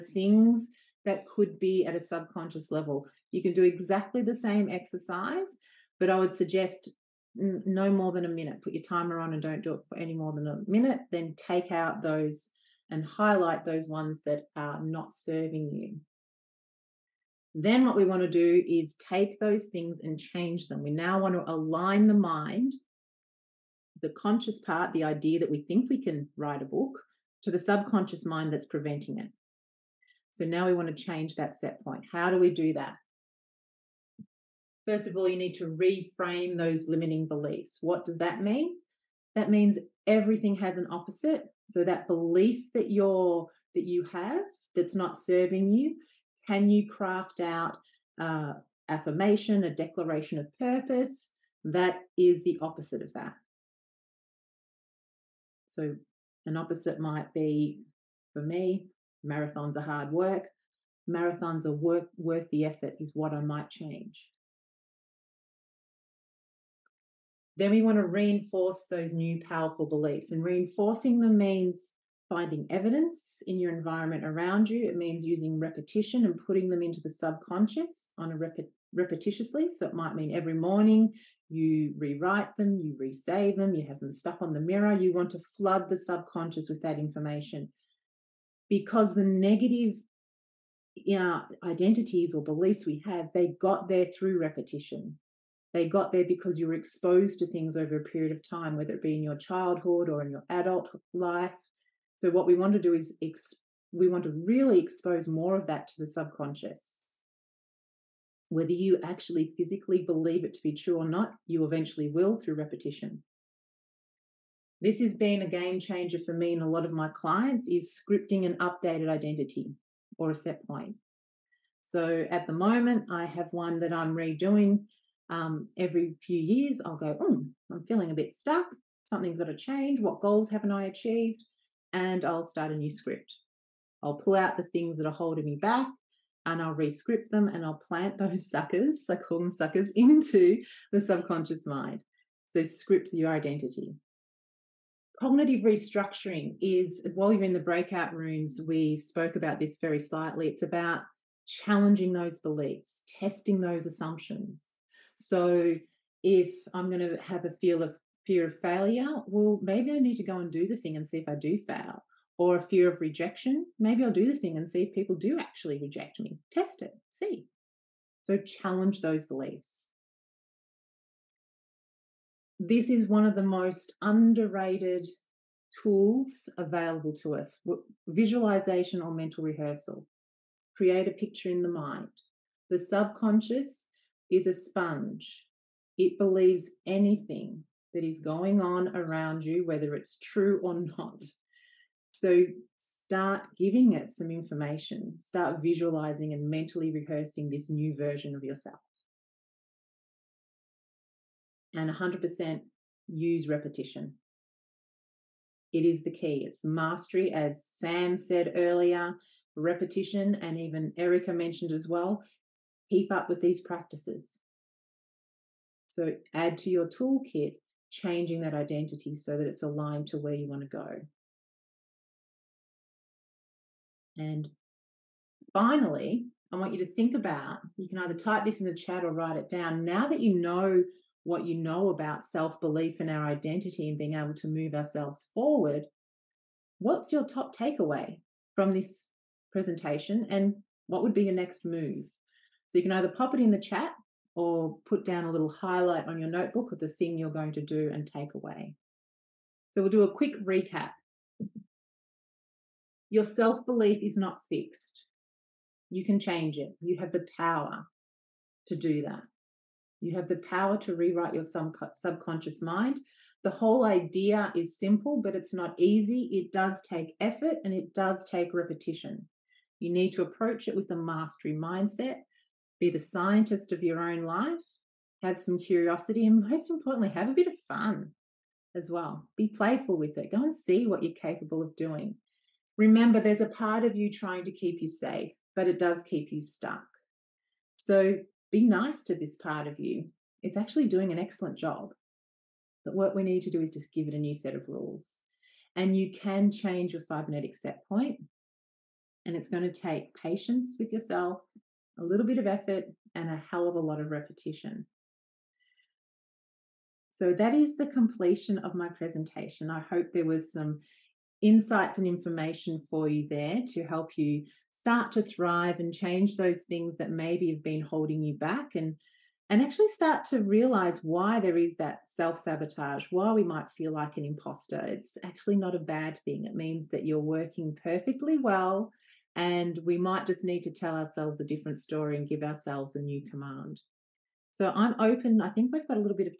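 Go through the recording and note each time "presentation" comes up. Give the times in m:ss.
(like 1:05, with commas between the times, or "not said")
3:59, 5:08.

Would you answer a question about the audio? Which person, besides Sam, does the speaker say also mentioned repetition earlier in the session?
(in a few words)
Erica.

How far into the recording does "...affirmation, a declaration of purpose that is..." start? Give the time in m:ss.
0:48.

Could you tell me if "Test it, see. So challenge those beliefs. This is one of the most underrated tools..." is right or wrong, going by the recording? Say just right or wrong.
right.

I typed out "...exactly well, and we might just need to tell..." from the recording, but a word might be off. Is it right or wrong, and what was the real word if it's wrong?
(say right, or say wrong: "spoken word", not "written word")
wrong: "perfectly", not "exactly".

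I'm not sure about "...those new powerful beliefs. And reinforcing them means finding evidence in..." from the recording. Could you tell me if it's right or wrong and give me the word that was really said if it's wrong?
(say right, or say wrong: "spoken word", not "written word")
right.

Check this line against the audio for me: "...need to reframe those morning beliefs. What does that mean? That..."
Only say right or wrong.
wrong.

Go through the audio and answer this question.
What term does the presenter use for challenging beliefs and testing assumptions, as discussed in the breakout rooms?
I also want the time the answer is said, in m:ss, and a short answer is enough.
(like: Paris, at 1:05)
Cognitive restructuring, at 2:25.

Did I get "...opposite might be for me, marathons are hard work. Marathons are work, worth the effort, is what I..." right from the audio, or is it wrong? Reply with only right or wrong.
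right.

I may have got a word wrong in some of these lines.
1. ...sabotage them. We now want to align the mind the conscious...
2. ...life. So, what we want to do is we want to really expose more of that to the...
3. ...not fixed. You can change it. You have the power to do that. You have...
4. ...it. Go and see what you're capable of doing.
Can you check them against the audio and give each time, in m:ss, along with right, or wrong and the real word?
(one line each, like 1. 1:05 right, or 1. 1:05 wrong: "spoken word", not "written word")
1. 0:20 wrong: "change", not "sabotage"
2. 1:41 right
3. 4:14 right
4. 4:40 right.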